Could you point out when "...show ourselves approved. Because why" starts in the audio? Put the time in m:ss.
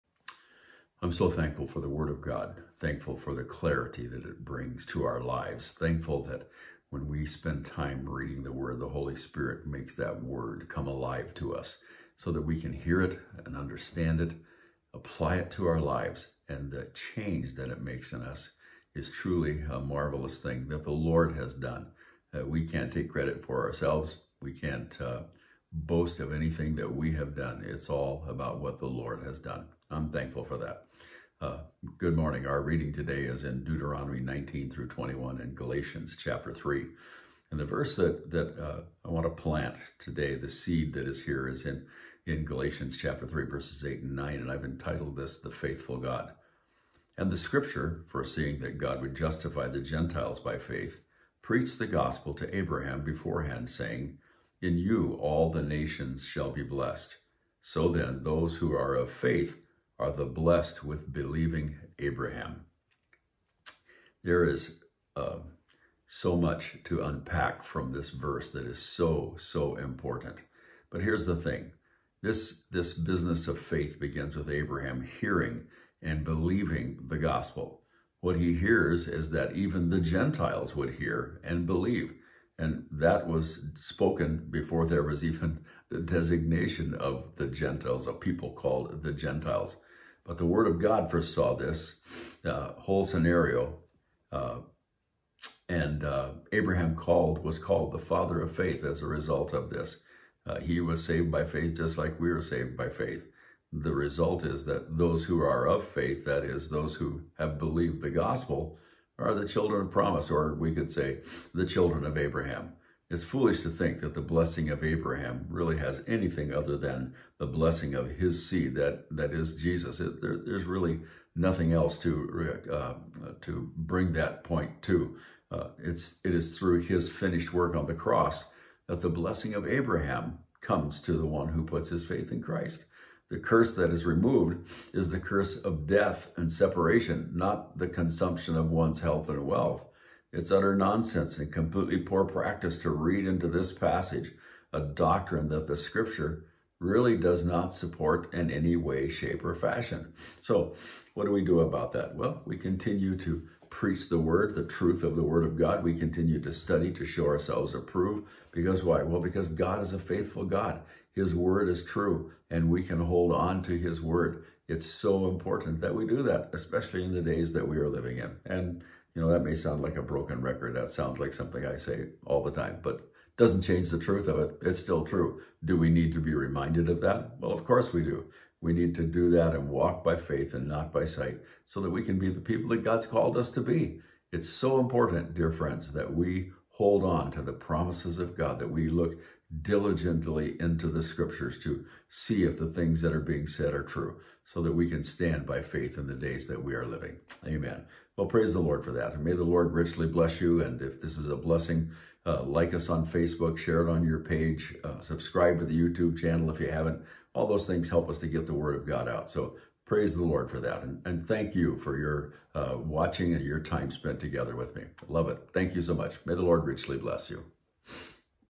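2:37.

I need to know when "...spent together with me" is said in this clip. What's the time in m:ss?
3:33.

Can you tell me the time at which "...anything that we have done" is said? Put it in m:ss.
0:26.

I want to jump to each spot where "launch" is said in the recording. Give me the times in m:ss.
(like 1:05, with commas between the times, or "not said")
not said.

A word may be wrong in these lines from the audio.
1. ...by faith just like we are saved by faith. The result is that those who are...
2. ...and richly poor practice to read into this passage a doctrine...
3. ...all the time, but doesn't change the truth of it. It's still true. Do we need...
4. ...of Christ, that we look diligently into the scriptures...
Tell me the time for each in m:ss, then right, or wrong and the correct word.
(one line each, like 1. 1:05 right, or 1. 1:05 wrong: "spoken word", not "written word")
1. 1:41 right
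2. 2:21 wrong: "completely", not "richly"
3. 2:52 right
4. 3:08 wrong: "God", not "Christ".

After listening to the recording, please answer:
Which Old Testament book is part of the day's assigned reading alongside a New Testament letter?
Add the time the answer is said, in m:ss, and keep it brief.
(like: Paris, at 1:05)
Deuteronomy, at 0:33.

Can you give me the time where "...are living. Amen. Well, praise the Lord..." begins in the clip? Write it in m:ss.
3:16.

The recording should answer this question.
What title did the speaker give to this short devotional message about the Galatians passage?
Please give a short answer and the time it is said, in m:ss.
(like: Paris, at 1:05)
The Faithful God, at 0:45.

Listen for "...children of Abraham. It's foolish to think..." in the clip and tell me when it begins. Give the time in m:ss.
1:51.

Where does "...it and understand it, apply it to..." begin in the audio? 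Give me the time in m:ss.
0:13.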